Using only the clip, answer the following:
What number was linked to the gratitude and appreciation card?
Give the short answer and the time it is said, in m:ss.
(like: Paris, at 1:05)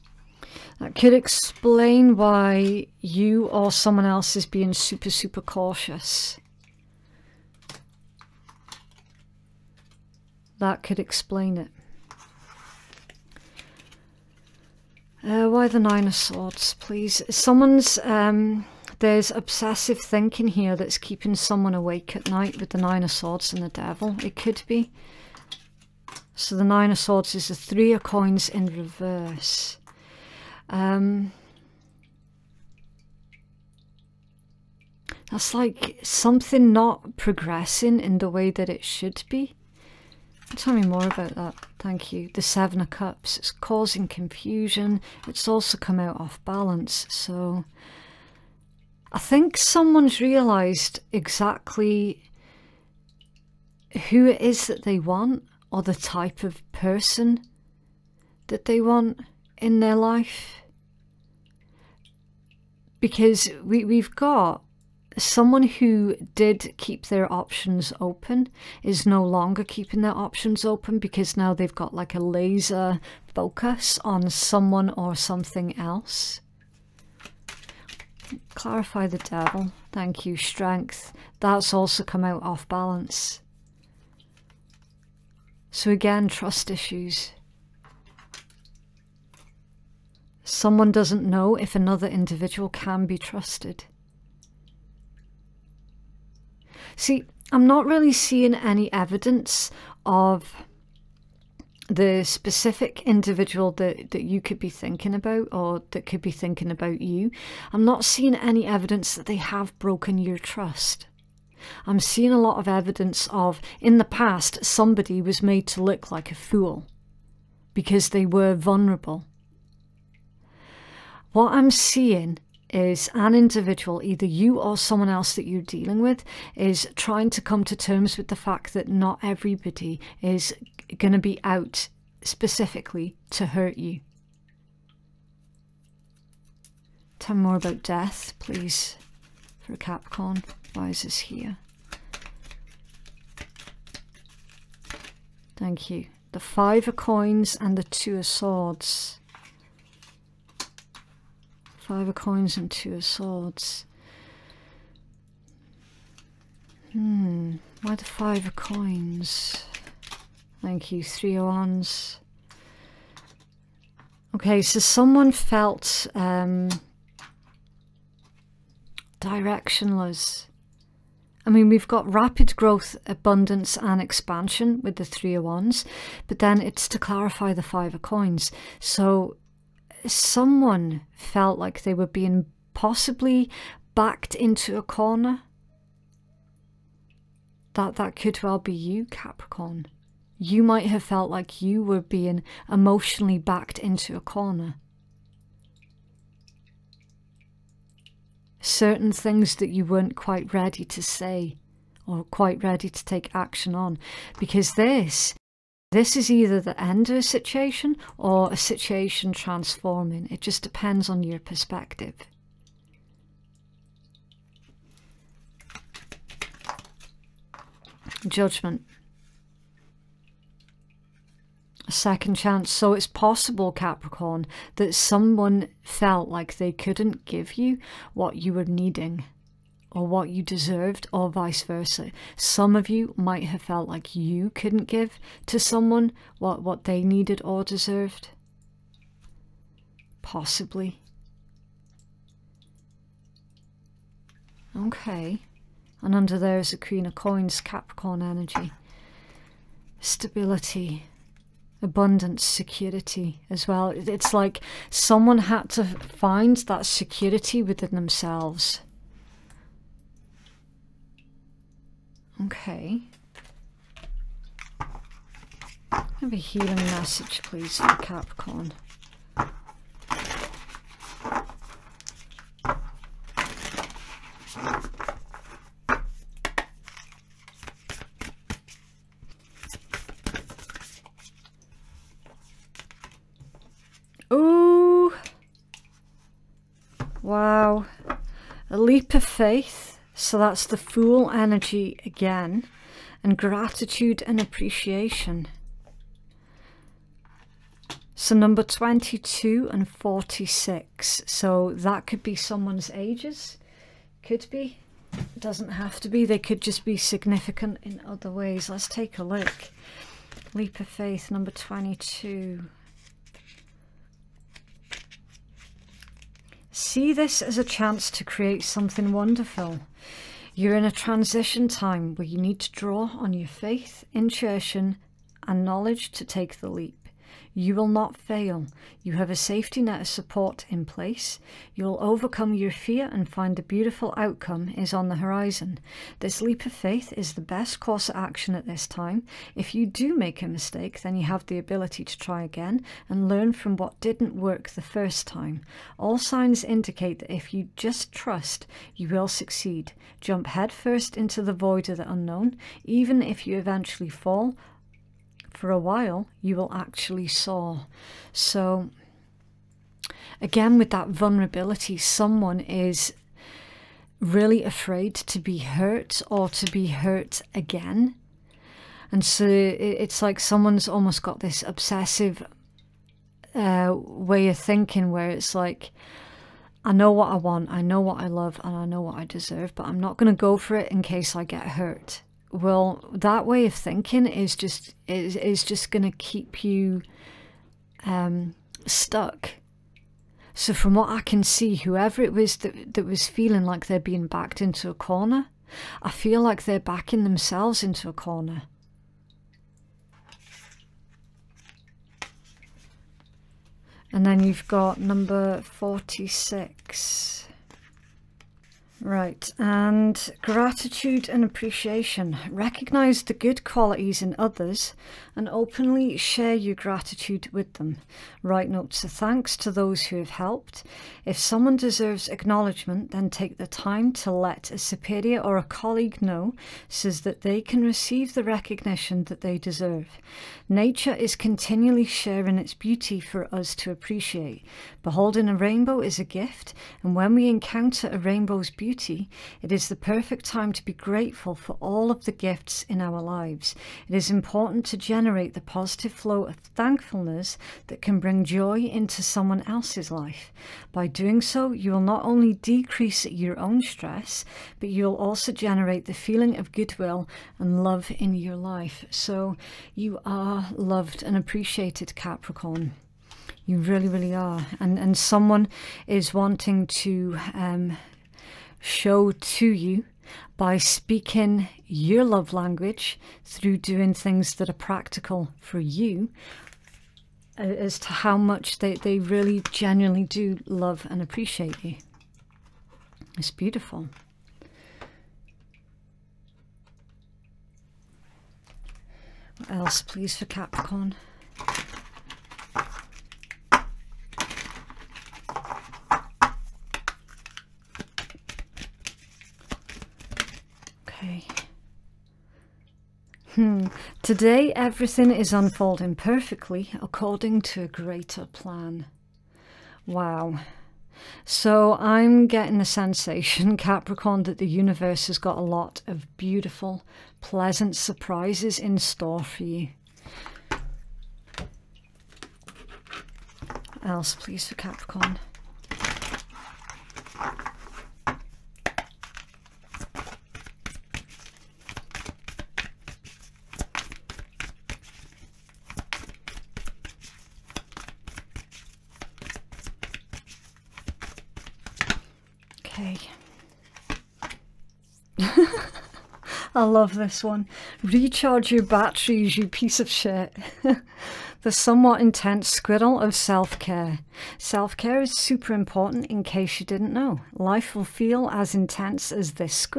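46, at 6:44.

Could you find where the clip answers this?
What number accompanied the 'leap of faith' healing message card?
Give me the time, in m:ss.
5:10.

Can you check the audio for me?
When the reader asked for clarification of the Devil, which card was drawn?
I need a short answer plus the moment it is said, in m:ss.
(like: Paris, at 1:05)
Strength, at 1:20.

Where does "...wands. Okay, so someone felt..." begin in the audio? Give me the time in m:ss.
2:41.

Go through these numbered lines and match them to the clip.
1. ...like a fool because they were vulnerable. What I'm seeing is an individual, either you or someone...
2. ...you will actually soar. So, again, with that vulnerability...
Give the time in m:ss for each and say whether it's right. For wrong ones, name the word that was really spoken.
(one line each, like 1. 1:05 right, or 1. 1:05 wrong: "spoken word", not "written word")
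1. 1:56 right
2. 5:56 right.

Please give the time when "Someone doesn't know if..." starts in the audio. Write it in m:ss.
1:30.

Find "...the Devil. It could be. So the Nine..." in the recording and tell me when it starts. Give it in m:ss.
0:23.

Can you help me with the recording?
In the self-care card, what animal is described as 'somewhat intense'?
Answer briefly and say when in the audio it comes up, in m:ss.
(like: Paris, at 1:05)
Squirrel, at 9:12.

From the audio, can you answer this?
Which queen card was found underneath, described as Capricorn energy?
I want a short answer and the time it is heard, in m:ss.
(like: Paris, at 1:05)
Queen of Coins, at 4:06.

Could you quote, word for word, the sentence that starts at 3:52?
Some of you might have felt like you couldn't give to someone what, what they needed or deserved.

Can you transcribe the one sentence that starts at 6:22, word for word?
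Well, that way of thinking is just is is just going to keep you um, stuck.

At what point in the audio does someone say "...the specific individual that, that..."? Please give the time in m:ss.
1:41.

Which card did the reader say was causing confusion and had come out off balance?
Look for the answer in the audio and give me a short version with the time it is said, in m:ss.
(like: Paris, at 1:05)
The Seven of Cups, at 0:42.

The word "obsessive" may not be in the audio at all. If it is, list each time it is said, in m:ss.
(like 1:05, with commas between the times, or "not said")
0:19, 6:11.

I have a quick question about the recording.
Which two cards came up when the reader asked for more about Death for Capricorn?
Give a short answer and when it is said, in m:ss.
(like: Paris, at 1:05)
Five of Coins and Two of Swords, at 2:26.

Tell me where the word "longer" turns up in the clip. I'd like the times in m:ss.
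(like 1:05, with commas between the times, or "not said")
1:09.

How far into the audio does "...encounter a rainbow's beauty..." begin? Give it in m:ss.
7:17.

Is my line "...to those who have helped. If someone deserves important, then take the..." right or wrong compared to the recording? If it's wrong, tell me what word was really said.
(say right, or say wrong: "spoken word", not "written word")
wrong: "acknowledgement", not "important".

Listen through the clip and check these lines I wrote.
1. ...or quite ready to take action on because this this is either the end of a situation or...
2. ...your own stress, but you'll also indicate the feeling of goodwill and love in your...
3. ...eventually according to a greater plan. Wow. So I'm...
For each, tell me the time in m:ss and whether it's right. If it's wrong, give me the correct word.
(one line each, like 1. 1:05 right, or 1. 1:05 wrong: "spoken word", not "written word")
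1. 3:22 right
2. 7:33 wrong: "generate", not "indicate"
3. 8:26 wrong: "perfectly", not "eventually".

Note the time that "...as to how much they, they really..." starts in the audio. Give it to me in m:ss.
7:57.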